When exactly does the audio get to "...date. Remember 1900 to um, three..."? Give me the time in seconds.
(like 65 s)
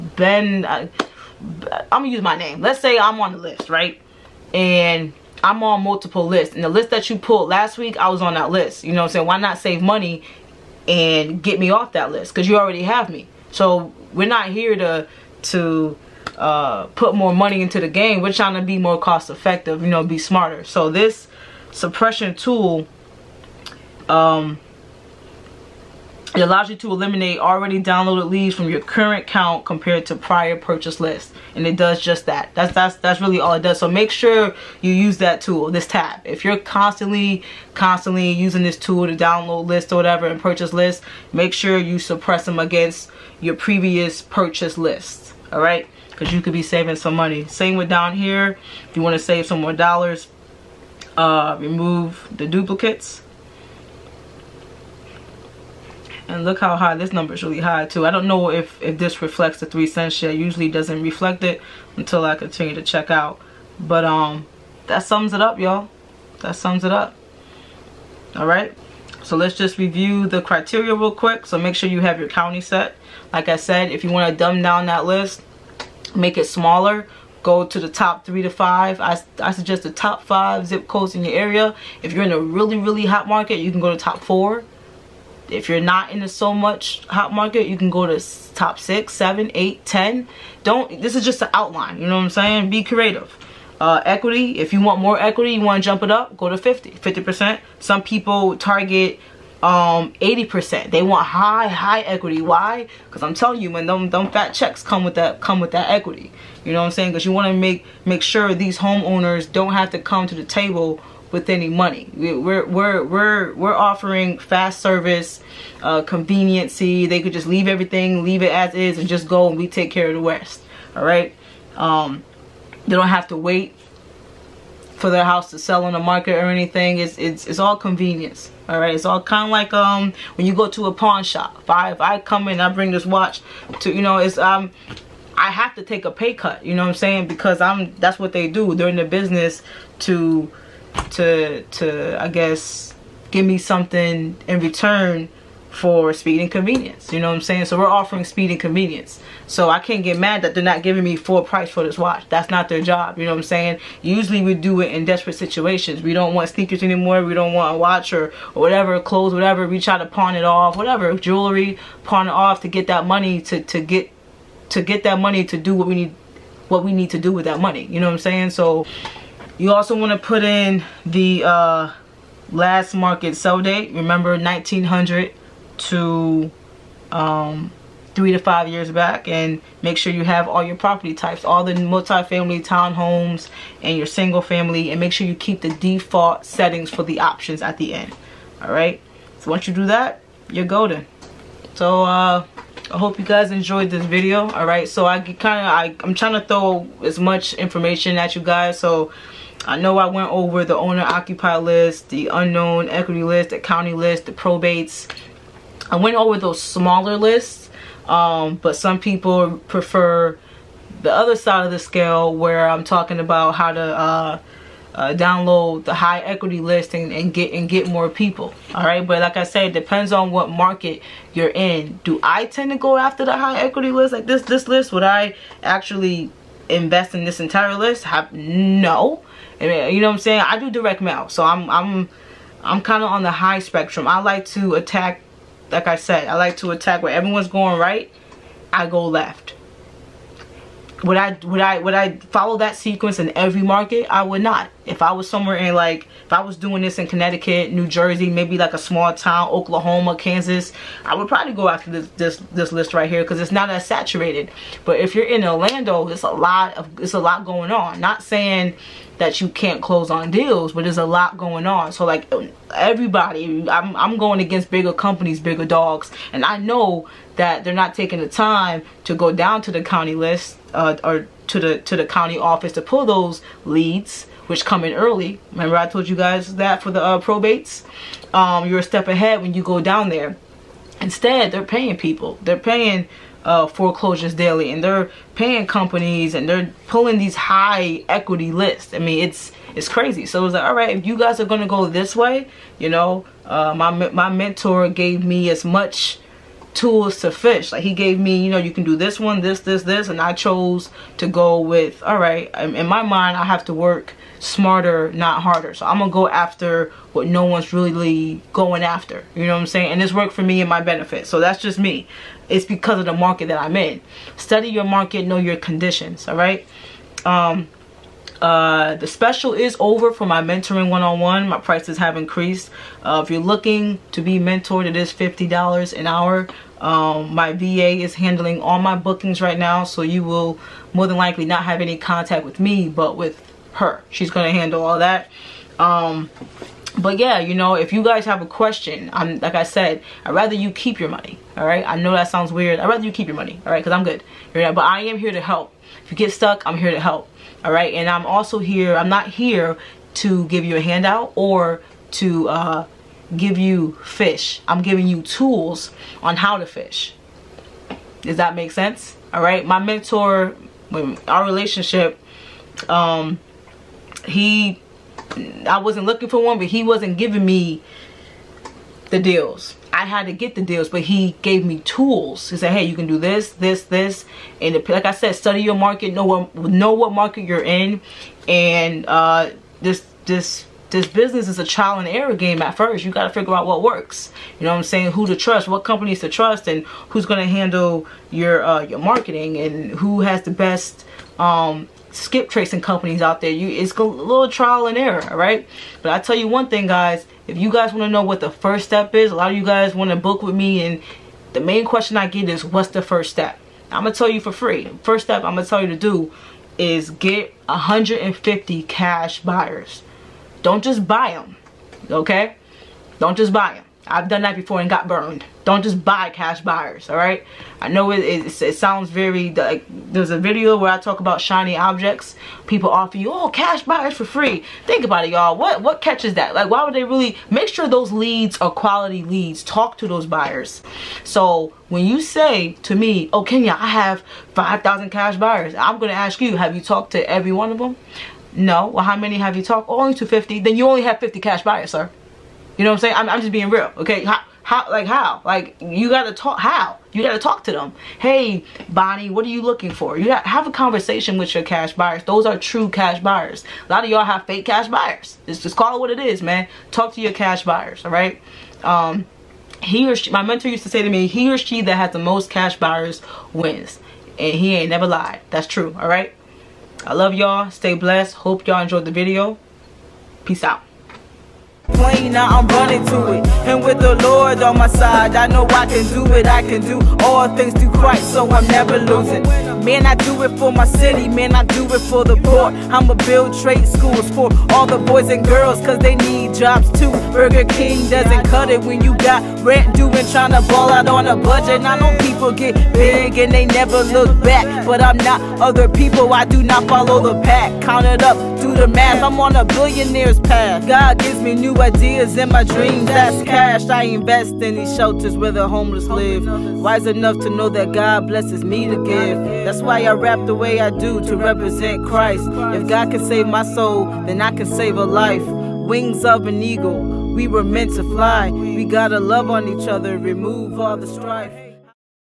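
173 s.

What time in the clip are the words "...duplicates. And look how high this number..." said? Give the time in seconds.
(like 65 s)
52 s.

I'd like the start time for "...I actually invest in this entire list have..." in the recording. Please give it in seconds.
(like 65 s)
225 s.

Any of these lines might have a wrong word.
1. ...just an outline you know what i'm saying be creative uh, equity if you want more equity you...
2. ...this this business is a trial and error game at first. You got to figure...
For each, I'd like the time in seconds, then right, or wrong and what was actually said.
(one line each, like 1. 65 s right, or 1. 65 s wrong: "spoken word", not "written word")
1. 91 s right
2. 380 s right.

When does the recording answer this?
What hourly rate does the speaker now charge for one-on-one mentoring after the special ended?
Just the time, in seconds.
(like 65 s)
325 s.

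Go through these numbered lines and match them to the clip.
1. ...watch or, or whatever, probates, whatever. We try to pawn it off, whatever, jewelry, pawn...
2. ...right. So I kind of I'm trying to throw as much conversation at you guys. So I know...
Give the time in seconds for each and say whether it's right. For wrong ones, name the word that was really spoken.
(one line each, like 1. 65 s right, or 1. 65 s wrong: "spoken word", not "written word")
1. 157 s wrong: "clothes", not "probates"
2. 194 s wrong: "information", not "conversation".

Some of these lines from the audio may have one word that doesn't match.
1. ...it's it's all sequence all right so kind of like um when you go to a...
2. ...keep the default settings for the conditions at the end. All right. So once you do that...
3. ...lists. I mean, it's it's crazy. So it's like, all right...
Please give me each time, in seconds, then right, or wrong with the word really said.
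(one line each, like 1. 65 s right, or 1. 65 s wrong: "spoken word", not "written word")
1. 127 s wrong: "convenience", not "sequence"
2. 185 s wrong: "options", not "conditions"
3. 288 s right.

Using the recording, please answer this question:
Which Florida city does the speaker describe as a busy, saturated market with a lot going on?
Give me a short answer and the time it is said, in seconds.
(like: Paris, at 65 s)
Orlando, at 255 s.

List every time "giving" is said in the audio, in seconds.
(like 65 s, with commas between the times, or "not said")
150 s, 354 s, 367 s.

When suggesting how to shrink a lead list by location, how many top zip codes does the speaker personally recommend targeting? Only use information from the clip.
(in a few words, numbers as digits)
5.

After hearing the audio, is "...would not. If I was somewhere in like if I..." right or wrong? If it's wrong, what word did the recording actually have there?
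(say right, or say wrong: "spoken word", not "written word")
right.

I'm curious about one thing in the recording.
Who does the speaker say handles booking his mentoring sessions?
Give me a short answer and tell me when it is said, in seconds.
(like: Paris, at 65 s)
VA, at 327 s.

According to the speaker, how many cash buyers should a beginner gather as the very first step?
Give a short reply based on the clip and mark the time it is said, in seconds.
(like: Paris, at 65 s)
150, at 407 s.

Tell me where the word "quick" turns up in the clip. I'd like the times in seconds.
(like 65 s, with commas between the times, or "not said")
71 s.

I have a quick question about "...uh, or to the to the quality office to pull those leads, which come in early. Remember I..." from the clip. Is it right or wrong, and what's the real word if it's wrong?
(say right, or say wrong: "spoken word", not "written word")
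wrong: "county", not "quality".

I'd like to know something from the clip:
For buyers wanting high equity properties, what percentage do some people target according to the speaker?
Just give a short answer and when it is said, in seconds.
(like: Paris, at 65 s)
80%, at 100 s.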